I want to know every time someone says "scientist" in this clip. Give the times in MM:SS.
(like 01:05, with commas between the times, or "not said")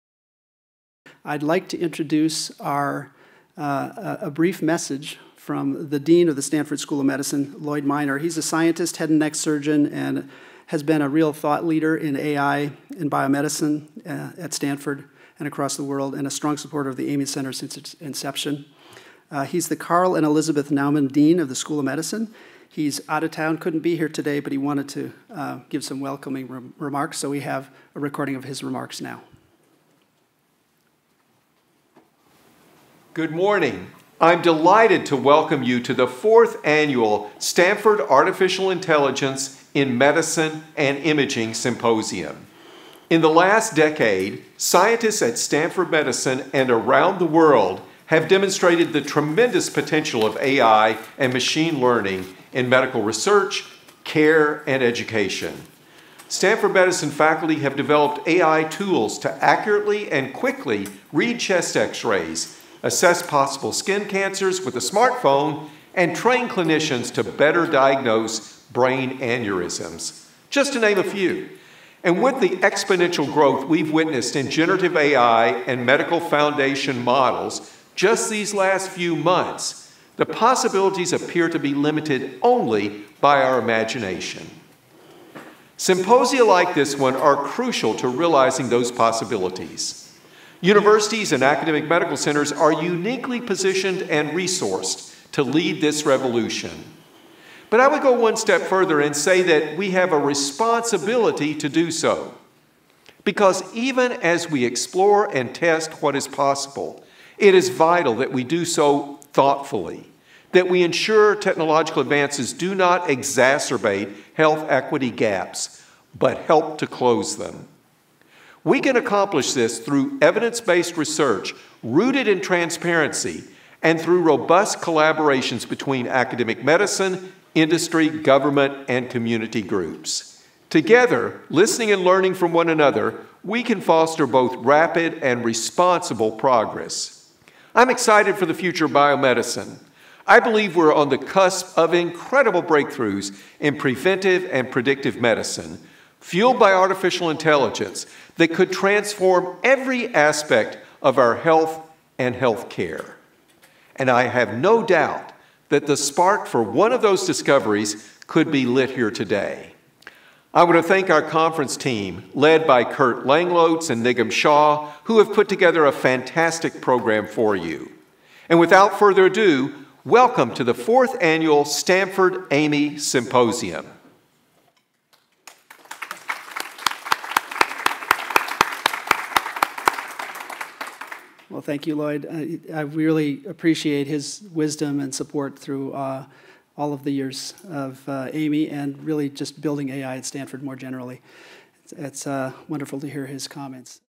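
00:08, 00:44.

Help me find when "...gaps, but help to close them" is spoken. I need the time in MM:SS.
01:55.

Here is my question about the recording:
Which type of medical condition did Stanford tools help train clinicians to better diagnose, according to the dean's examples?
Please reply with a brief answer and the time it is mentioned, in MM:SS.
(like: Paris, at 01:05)
brain aneurysms, at 01:08.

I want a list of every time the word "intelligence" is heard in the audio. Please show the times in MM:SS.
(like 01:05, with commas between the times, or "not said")
00:38, 02:27.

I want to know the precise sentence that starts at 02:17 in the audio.
I'm excited for the future of biomedicine.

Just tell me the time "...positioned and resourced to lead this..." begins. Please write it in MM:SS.
01:33.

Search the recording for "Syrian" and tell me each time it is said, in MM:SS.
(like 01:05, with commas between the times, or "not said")
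not said.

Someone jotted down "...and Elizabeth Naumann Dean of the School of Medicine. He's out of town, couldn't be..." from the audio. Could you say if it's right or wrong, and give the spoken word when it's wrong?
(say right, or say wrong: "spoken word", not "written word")
right.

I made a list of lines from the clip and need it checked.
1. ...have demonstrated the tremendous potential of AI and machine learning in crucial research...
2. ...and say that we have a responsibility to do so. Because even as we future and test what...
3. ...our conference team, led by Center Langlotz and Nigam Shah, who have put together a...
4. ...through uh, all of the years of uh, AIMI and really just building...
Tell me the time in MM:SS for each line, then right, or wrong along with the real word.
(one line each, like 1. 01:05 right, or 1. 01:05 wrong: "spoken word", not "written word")
1. 00:48 wrong: "medical", not "crucial"
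2. 01:39 wrong: "explore", not "future"
3. 02:41 wrong: "Curt", not "Center"
4. 03:05 right.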